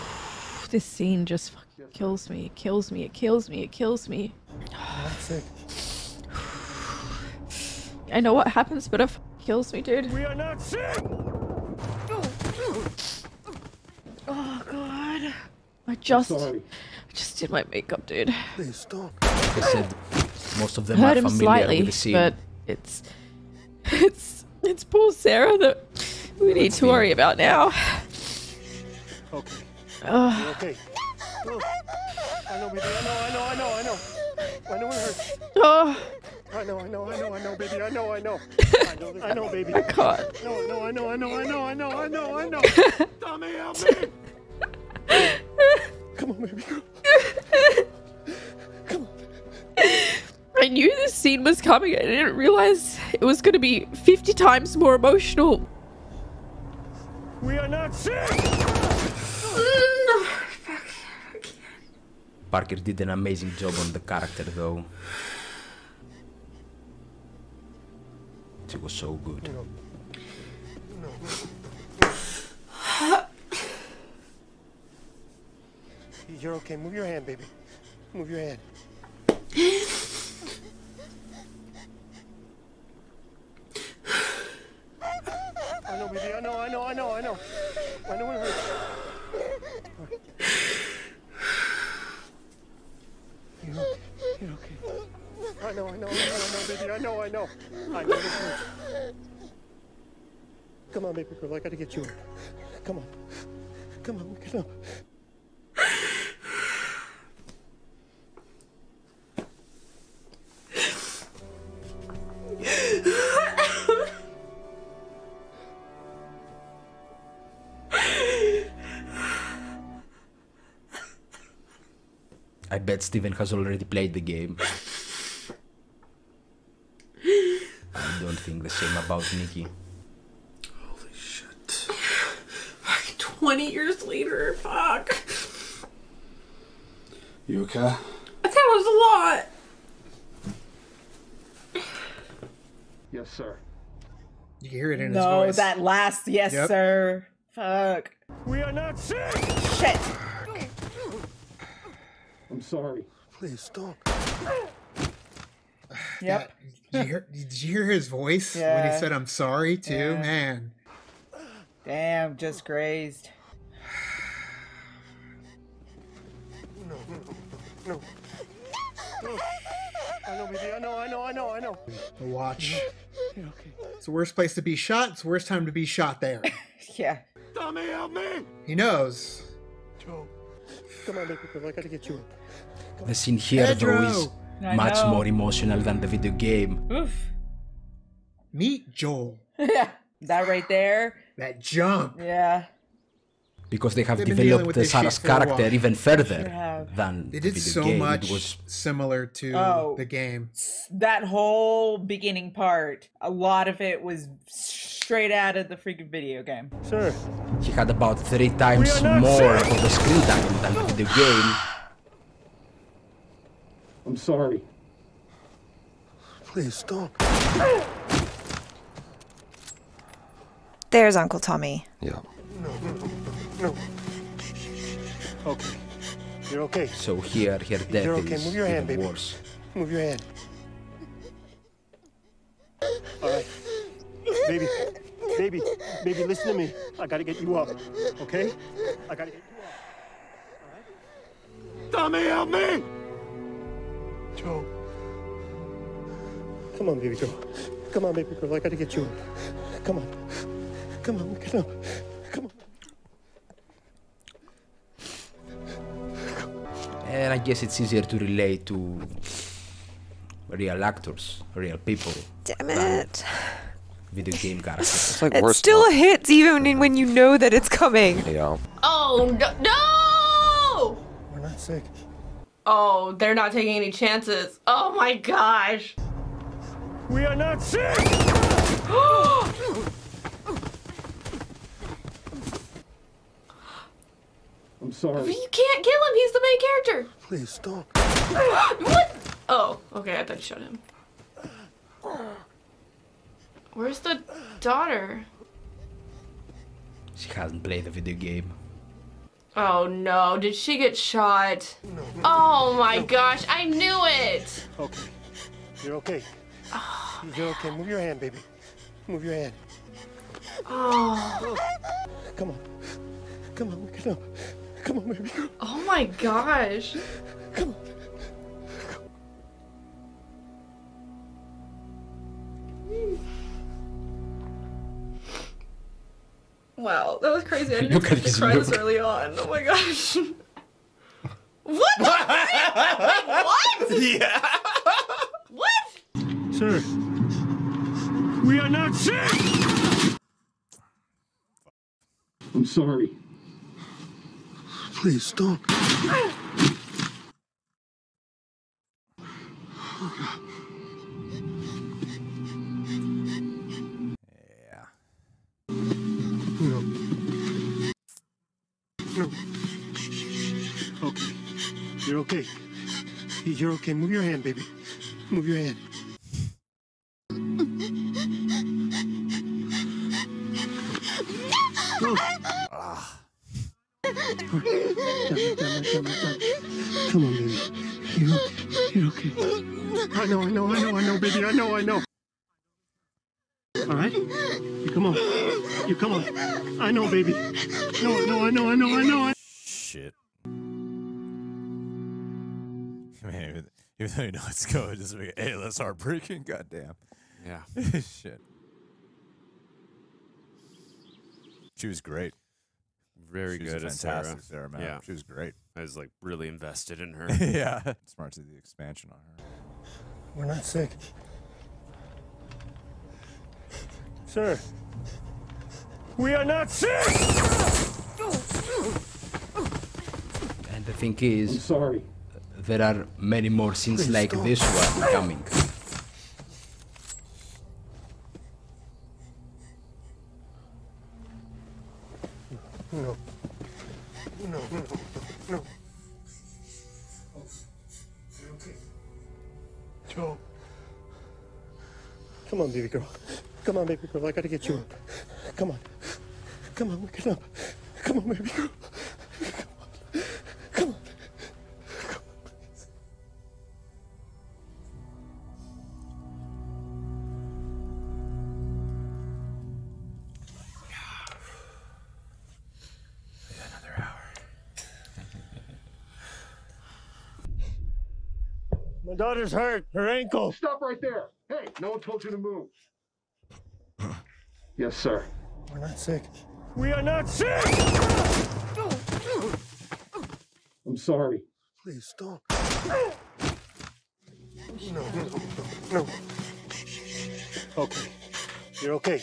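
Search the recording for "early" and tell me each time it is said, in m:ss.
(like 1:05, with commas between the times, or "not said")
5:28.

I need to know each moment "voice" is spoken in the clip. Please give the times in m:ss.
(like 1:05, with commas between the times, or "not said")
2:25, 2:38.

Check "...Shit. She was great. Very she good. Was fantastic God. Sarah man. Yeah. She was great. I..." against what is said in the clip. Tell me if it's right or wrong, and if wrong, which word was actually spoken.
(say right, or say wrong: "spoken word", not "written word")
wrong: "Sarah", not "God".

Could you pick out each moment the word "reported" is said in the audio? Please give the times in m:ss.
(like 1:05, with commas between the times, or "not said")
not said.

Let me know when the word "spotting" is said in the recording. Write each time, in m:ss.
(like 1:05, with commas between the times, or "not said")
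not said.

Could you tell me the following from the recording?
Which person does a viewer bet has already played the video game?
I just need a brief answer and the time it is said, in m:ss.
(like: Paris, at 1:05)
Steven, at 2:03.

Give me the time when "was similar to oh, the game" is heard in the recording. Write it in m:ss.
3:18.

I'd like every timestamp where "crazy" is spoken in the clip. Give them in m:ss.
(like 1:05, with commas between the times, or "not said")
5:27.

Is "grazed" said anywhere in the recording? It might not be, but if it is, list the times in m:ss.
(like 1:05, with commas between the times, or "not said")
2:42.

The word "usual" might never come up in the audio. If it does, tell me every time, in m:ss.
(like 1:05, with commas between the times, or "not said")
not said.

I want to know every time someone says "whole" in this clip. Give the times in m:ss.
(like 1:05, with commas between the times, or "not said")
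3:21.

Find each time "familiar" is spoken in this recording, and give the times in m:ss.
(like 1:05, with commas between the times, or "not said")
0:21.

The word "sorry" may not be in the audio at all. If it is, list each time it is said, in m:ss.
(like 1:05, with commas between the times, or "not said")
2:32, 2:39, 3:34, 4:44, 5:42, 7:01, 8:00.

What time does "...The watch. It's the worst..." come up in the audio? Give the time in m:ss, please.
2:52.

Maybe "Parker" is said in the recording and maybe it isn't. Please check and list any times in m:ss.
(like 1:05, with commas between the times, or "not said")
1:02.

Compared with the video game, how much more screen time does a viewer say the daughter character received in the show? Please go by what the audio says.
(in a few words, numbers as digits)
Three times more.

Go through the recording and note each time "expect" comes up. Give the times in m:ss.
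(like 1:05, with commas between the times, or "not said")
5:27.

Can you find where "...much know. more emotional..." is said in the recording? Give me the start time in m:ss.
3:04.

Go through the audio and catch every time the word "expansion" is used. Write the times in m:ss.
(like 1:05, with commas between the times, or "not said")
6:48.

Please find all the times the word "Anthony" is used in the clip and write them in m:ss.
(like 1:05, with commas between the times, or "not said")
not said.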